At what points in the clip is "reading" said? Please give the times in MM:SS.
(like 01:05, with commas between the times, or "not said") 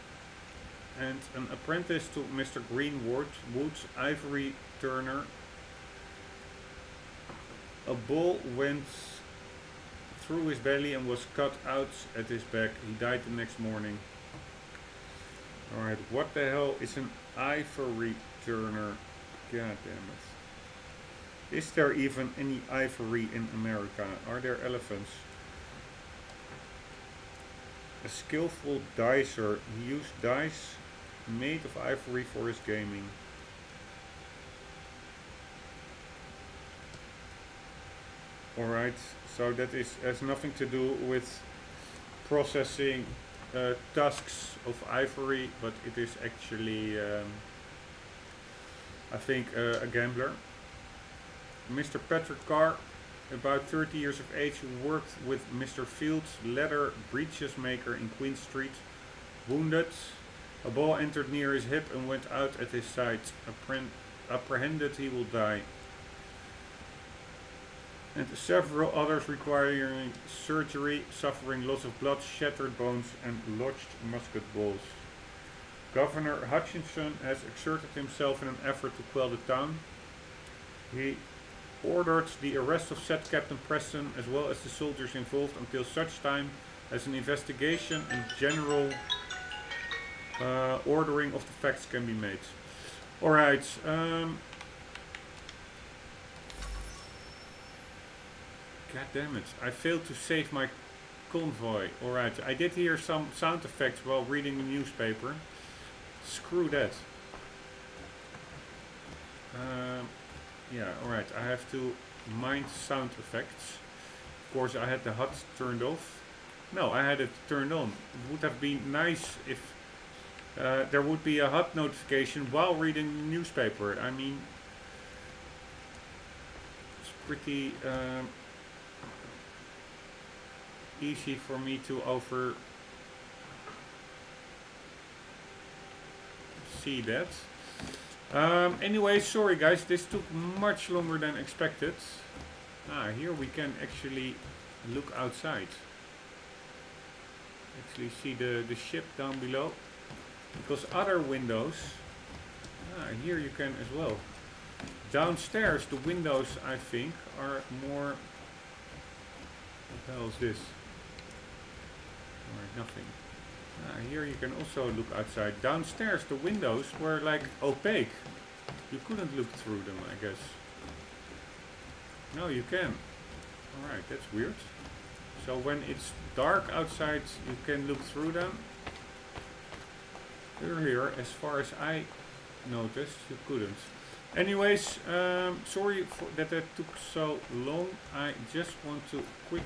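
01:44, 02:02.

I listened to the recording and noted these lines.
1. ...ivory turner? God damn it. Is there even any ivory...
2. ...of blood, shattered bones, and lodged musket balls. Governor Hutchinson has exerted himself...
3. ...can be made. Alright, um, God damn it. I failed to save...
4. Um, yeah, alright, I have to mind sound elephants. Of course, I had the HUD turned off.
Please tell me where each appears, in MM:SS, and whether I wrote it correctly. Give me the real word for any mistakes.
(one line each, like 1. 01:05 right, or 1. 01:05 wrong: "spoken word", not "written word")
1. 00:17 right
2. 01:11 right
3. 01:31 right
4. 01:49 wrong: "effects", not "elephants".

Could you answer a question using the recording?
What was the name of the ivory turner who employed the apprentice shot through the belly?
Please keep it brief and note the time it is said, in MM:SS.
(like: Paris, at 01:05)
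Mr. Greenwood, at 00:02.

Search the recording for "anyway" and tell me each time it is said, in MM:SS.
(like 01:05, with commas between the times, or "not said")
02:18, 03:04.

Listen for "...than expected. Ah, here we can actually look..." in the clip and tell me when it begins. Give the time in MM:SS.
02:21.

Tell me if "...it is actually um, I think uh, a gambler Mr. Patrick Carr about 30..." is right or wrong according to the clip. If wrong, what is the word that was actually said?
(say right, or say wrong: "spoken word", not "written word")
right.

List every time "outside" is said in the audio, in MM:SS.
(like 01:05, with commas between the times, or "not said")
02:25, 02:45, 02:56.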